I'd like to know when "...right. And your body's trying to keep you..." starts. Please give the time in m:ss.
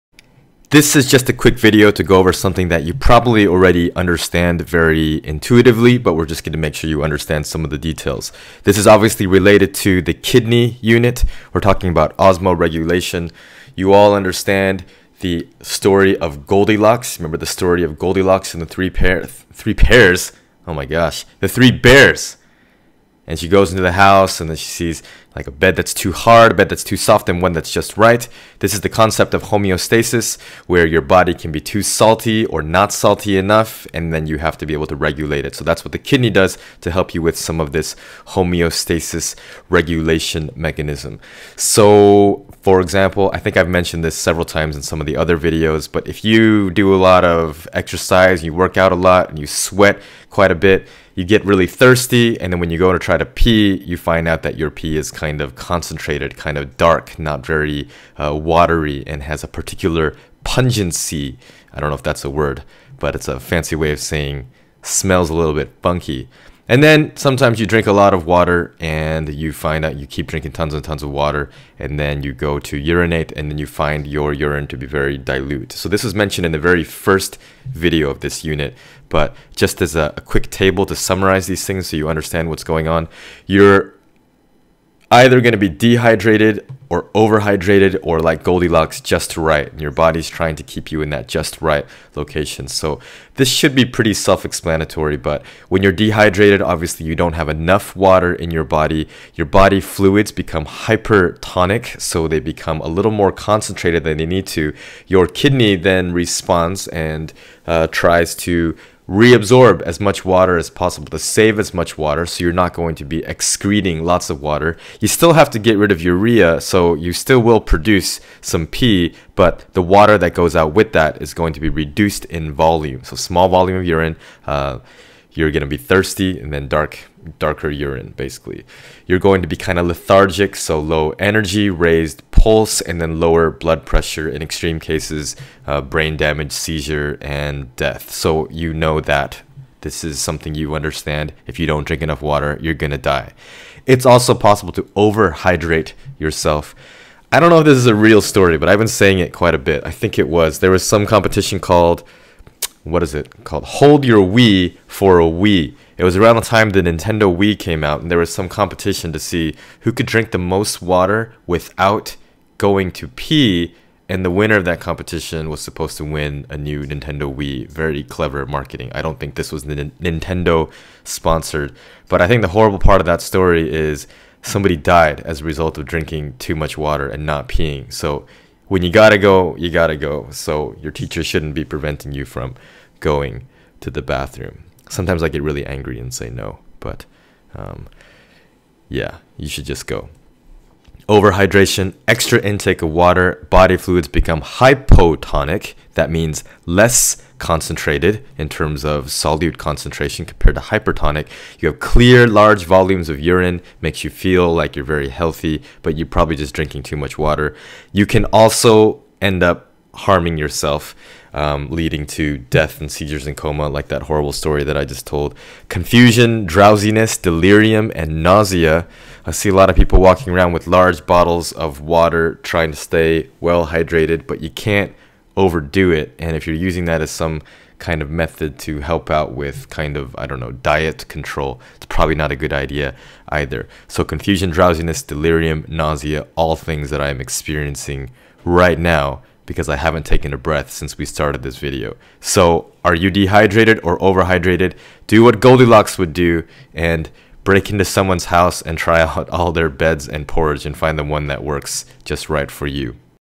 1:29.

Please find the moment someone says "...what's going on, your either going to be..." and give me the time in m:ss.
1:22.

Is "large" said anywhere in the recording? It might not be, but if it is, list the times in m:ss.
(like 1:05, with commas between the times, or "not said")
3:22, 3:40.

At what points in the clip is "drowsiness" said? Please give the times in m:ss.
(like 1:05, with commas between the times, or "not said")
3:36, 3:54.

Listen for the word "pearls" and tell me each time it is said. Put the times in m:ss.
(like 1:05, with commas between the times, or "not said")
not said.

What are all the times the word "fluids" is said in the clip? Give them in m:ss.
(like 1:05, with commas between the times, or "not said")
1:39, 3:13.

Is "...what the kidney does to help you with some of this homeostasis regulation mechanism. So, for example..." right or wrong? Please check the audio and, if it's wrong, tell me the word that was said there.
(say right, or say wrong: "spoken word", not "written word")
right.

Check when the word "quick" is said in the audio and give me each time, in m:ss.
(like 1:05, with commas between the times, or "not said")
0:01, 1:20.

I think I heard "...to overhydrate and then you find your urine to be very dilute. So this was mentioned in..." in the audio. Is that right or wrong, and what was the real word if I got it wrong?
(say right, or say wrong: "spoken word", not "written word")
wrong: "urinate", not "overhydrate".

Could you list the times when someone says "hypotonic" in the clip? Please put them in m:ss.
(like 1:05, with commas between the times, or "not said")
3:14.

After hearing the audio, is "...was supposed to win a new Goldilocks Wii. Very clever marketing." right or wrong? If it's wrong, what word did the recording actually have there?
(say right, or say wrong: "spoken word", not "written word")
wrong: "Nintendo", not "Goldilocks".